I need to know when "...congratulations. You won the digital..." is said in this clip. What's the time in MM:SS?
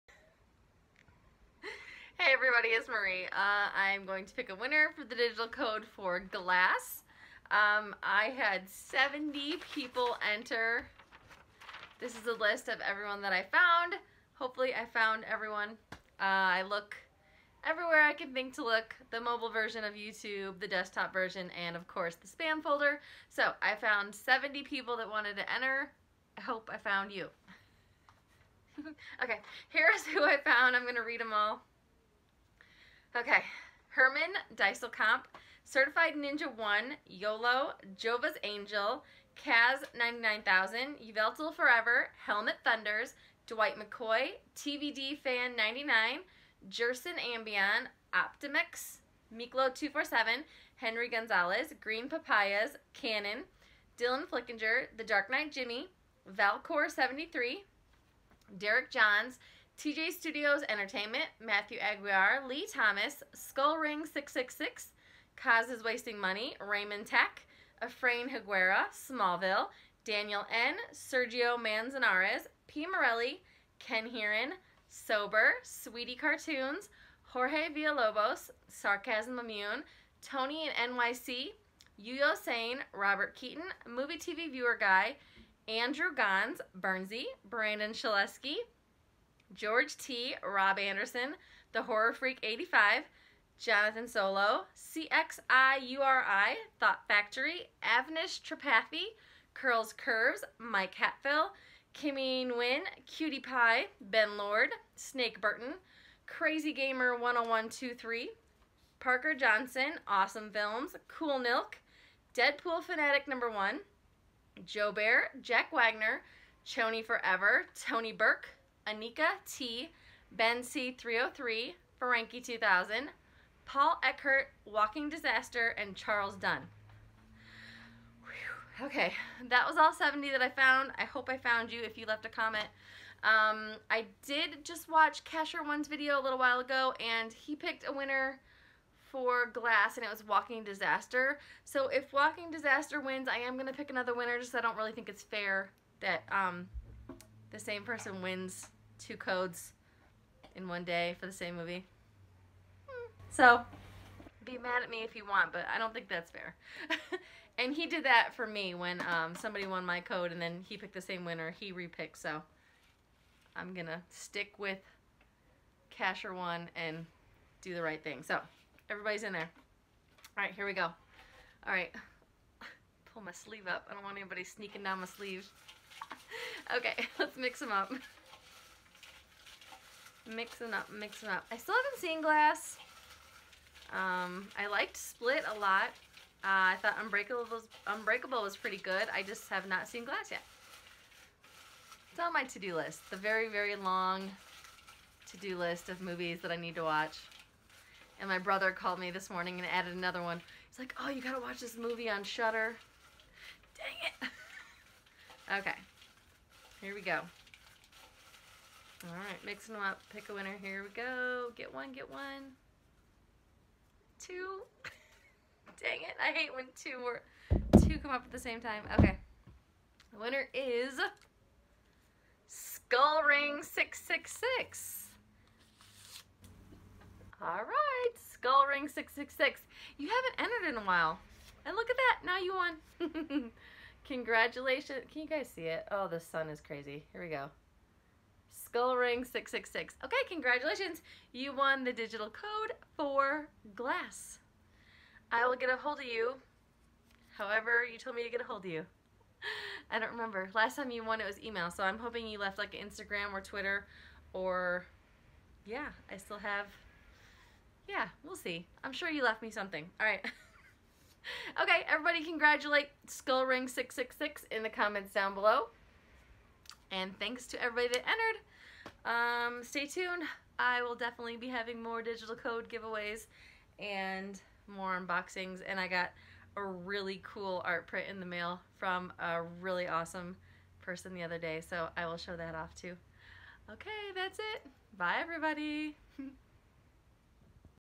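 04:00.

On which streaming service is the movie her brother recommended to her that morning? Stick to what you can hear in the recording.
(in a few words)
Shudder.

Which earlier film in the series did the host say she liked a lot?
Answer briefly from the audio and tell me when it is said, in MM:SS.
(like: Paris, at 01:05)
Split, at 03:04.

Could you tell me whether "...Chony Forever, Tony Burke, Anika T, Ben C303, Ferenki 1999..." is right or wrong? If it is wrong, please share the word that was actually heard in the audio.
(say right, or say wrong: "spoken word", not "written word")
wrong: "2000", not "1999".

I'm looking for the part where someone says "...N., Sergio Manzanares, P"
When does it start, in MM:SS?
01:10.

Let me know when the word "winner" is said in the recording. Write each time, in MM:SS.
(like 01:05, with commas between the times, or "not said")
00:04, 02:17, 02:24, 02:41, 03:30, 03:40.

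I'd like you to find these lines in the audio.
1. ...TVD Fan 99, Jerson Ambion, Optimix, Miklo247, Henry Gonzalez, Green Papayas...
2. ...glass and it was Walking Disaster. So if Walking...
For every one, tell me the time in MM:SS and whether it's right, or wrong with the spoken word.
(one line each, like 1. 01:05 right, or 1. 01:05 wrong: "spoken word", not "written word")
1. 00:44 right
2. 02:19 right.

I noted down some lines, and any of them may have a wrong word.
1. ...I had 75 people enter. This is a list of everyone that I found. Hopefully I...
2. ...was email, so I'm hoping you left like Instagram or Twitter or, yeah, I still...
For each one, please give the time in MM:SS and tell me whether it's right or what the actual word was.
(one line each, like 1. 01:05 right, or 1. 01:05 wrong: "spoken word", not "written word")
1. 00:08 wrong: "70", not "75"
2. 04:11 right.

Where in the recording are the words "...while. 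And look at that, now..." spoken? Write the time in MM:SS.
03:50.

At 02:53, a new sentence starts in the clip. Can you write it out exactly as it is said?
I don't want anybody sneaking down my sleeve.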